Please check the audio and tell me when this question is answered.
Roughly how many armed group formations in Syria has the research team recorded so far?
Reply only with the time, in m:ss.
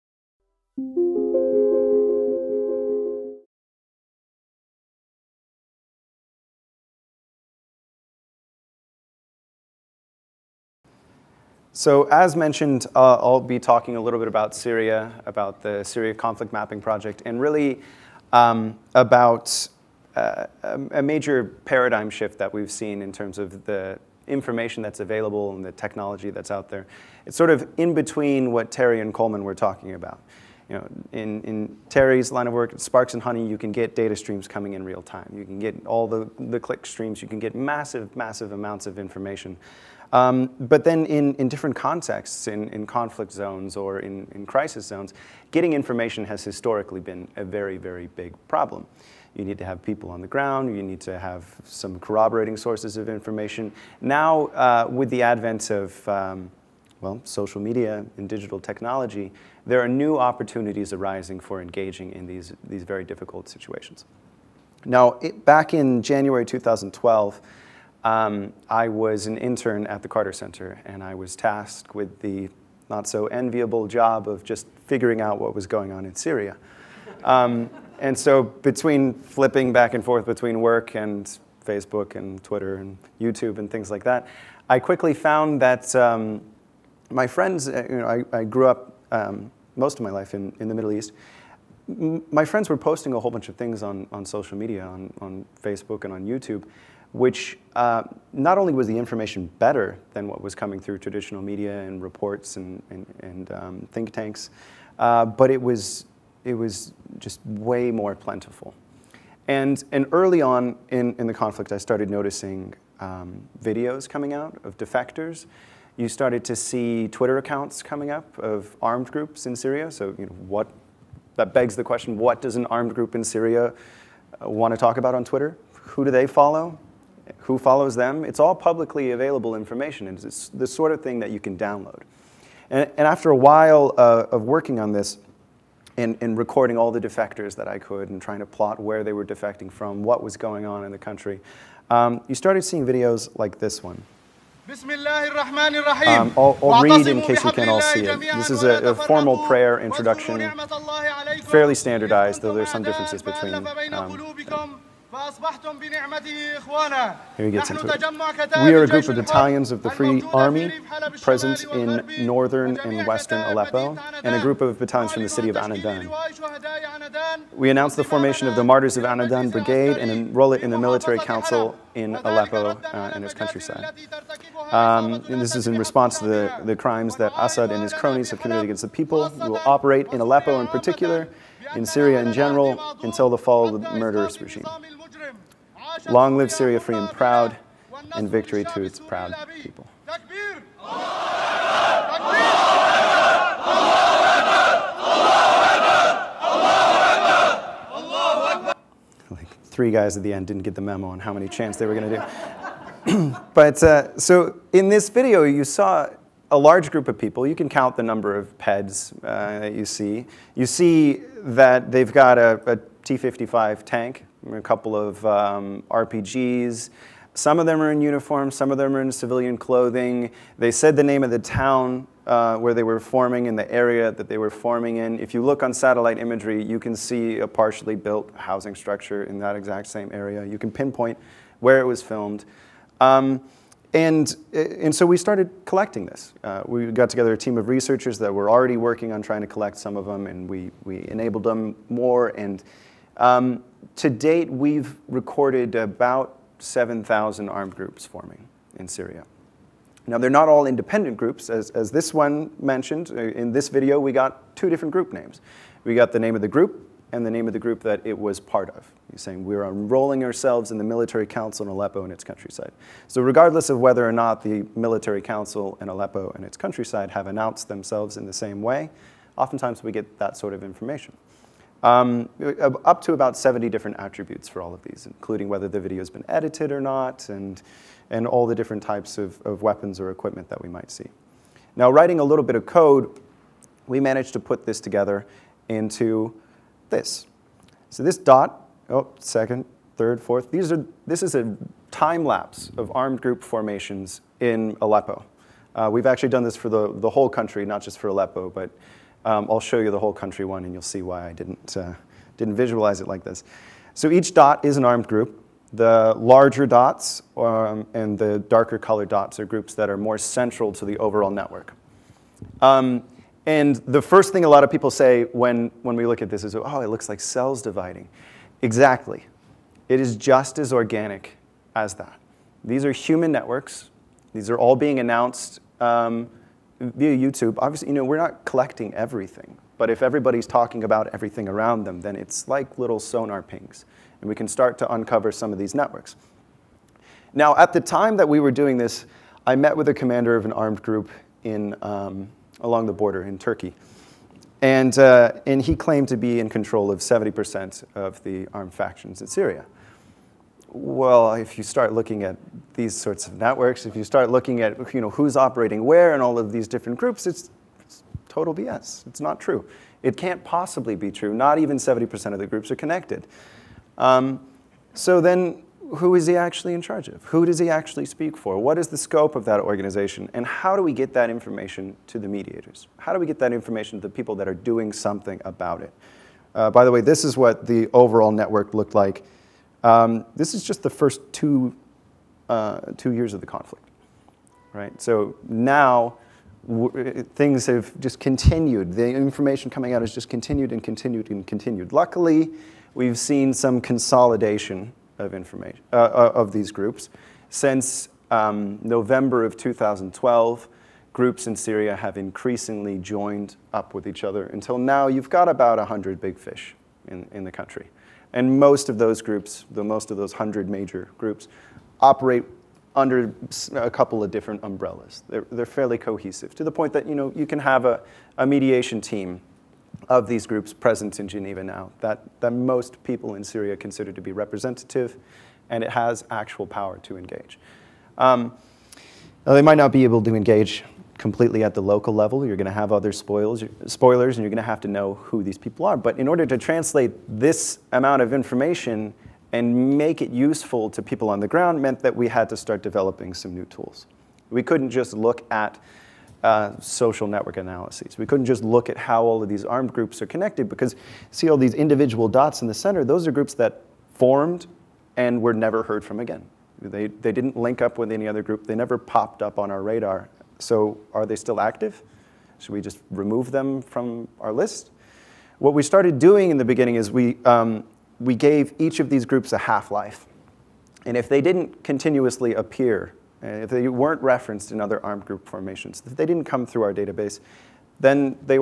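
4:06.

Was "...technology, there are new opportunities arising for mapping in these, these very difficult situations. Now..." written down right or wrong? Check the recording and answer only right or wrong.
wrong.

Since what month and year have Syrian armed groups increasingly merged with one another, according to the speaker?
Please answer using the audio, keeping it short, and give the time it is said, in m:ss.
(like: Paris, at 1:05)
November 2012, at 6:38.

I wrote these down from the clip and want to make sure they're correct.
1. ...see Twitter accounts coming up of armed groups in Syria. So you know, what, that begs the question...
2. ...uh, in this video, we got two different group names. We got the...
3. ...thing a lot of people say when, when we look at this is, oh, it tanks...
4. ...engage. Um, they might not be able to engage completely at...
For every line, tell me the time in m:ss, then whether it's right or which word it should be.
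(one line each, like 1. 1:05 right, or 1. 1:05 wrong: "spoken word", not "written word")
1. 1:56 right
2. 4:13 right
3. 5:14 wrong: "looks", not "tanks"
4. 7:07 right.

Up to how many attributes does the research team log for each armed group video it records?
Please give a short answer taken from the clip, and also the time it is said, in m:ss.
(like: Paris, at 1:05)
70, at 4:33.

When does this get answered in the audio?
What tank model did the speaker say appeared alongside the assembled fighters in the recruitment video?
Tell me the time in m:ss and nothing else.
3:33.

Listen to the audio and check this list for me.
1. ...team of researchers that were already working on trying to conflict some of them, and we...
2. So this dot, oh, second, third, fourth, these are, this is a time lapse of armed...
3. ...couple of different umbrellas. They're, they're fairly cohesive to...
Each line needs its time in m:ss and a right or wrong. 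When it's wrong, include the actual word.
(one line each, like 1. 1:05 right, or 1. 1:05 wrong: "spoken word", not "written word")
1. 3:57 wrong: "collect", not "conflict"
2. 4:47 right
3. 6:53 right.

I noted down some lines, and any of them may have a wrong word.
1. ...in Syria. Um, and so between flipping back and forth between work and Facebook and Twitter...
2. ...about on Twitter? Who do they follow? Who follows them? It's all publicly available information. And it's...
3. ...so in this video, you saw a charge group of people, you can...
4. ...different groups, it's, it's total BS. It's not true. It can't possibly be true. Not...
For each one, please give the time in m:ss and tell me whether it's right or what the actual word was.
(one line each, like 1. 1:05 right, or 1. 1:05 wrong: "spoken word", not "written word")
1. 1:16 right
2. 2:04 right
3. 3:24 wrong: "large", not "charge"
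4. 5:56 right.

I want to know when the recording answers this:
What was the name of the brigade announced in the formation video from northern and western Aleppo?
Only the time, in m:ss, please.
2:48.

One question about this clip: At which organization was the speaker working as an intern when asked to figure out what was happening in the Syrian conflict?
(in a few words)
Carter Center.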